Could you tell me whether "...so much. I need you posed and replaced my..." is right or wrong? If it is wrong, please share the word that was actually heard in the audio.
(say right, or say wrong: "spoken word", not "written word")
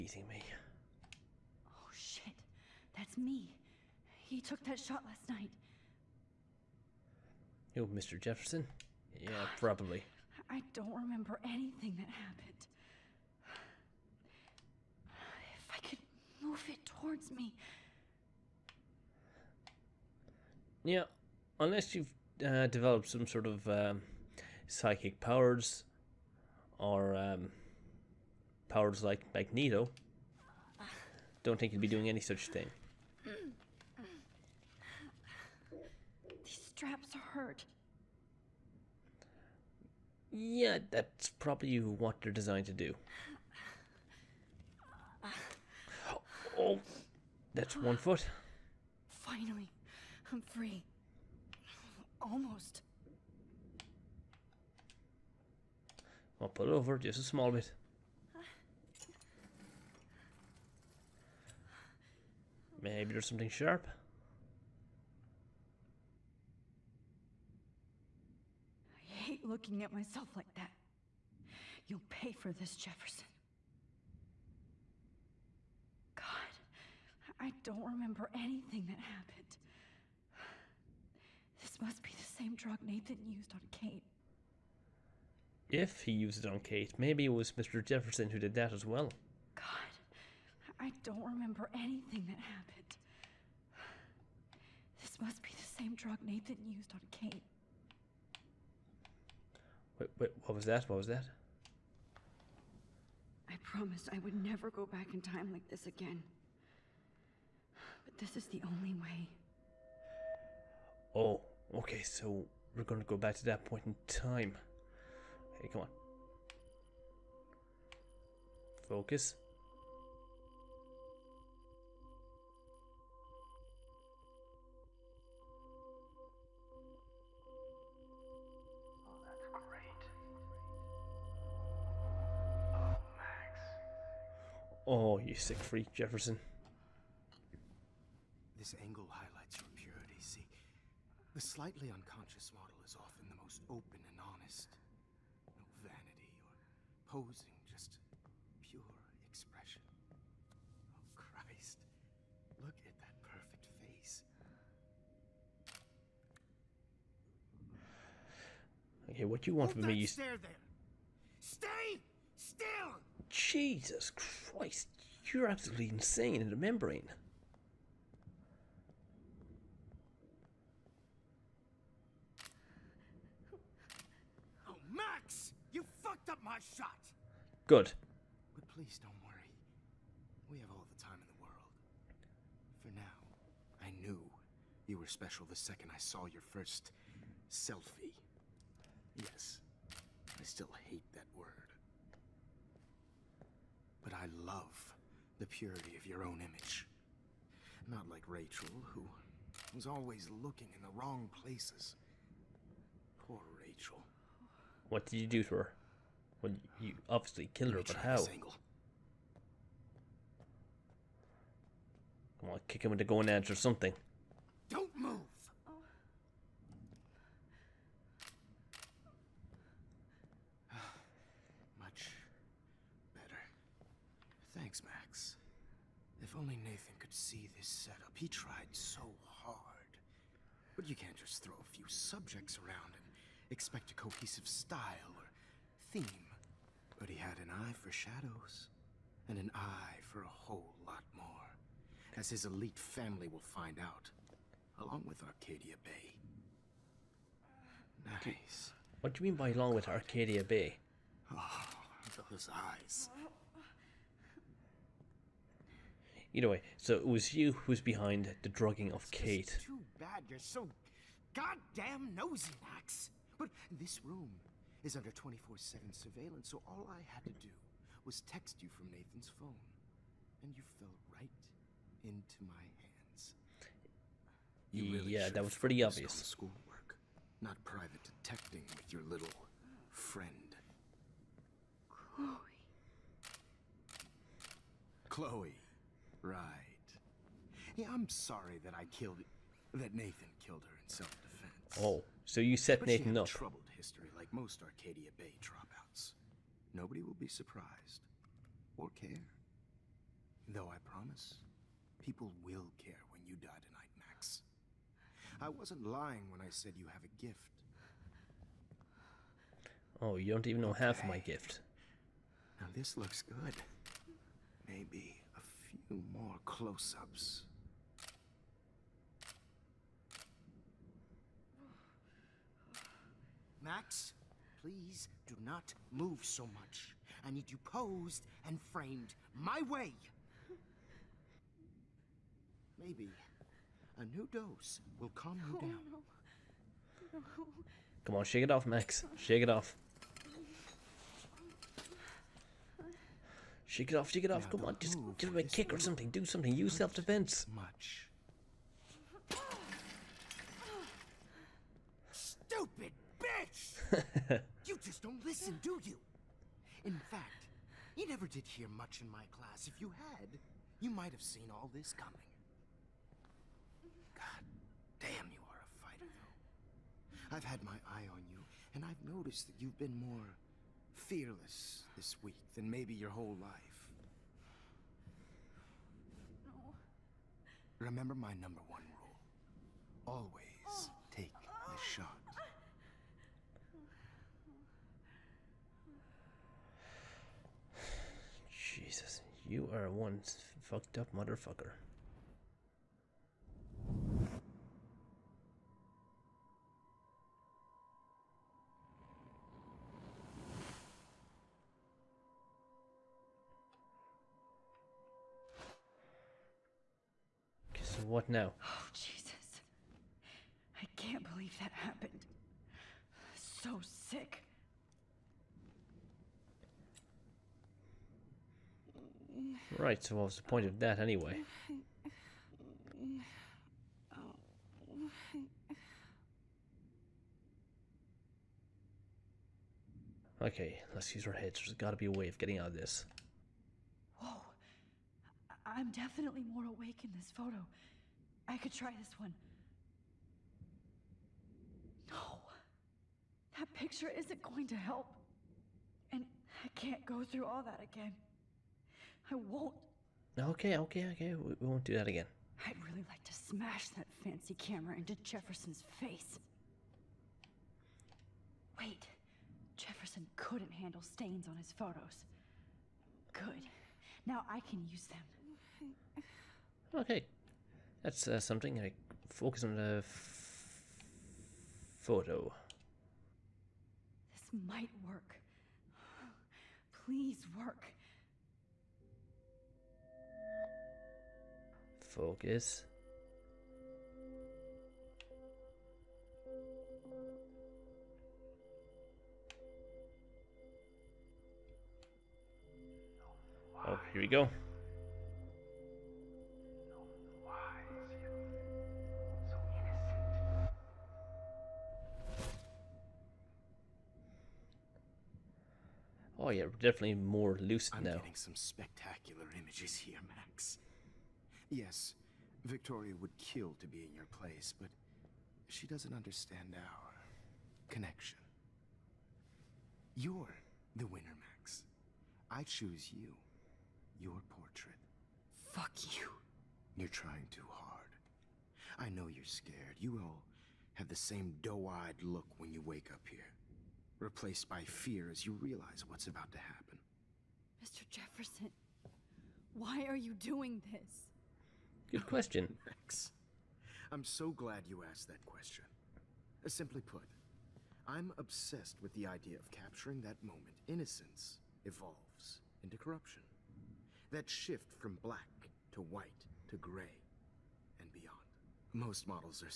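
wrong: "framed", not "replaced".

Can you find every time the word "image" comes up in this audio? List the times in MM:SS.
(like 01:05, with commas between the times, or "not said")
03:16, 08:29.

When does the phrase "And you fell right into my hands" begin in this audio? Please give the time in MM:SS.
04:30.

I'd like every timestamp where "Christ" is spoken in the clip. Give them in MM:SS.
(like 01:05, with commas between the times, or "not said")
02:31, 02:44.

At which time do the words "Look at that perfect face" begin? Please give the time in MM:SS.
02:32.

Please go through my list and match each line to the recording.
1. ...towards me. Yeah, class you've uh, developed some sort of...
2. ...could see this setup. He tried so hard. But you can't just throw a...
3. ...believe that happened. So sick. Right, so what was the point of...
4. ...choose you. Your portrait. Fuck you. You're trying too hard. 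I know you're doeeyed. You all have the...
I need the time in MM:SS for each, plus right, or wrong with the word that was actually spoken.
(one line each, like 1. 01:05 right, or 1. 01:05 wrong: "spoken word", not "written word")
1. 00:16 wrong: "unless", not "class"
2. 03:46 right
3. 06:51 right
4. 08:42 wrong: "scared", not "doeeyed".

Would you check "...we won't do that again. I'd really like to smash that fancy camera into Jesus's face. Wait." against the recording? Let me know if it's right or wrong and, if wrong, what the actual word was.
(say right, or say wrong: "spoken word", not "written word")
wrong: "Jefferson", not "Jesus".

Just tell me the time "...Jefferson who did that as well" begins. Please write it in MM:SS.
01:27.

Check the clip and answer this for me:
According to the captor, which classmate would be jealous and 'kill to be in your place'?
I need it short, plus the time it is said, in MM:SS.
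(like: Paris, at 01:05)
Victoria, at 08:32.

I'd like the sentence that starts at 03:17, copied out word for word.
Not like Rachel, who was always looking in the wrong places.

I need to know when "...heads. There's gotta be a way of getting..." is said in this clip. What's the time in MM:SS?
07:11.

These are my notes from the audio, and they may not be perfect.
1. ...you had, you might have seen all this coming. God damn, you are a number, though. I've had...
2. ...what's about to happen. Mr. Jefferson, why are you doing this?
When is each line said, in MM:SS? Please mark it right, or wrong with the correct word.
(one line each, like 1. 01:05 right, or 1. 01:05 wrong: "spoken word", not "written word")
1. 05:59 wrong: "fighter", not "number"
2. 08:56 right.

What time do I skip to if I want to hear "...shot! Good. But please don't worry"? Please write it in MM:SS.
02:56.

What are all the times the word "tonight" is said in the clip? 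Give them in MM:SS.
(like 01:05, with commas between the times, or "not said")
05:03.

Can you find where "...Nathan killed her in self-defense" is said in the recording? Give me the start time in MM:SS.
04:49.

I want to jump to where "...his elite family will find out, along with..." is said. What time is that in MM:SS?
04:02.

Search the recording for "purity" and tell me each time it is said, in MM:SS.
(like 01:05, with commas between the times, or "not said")
02:19, 03:15.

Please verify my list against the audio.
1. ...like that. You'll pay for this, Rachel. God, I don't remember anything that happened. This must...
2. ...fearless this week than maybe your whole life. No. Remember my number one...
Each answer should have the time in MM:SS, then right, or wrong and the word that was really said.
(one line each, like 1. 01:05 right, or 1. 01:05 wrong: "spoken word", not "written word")
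1. 01:10 wrong: "Jefferson", not "Rachel"
2. 06:10 right.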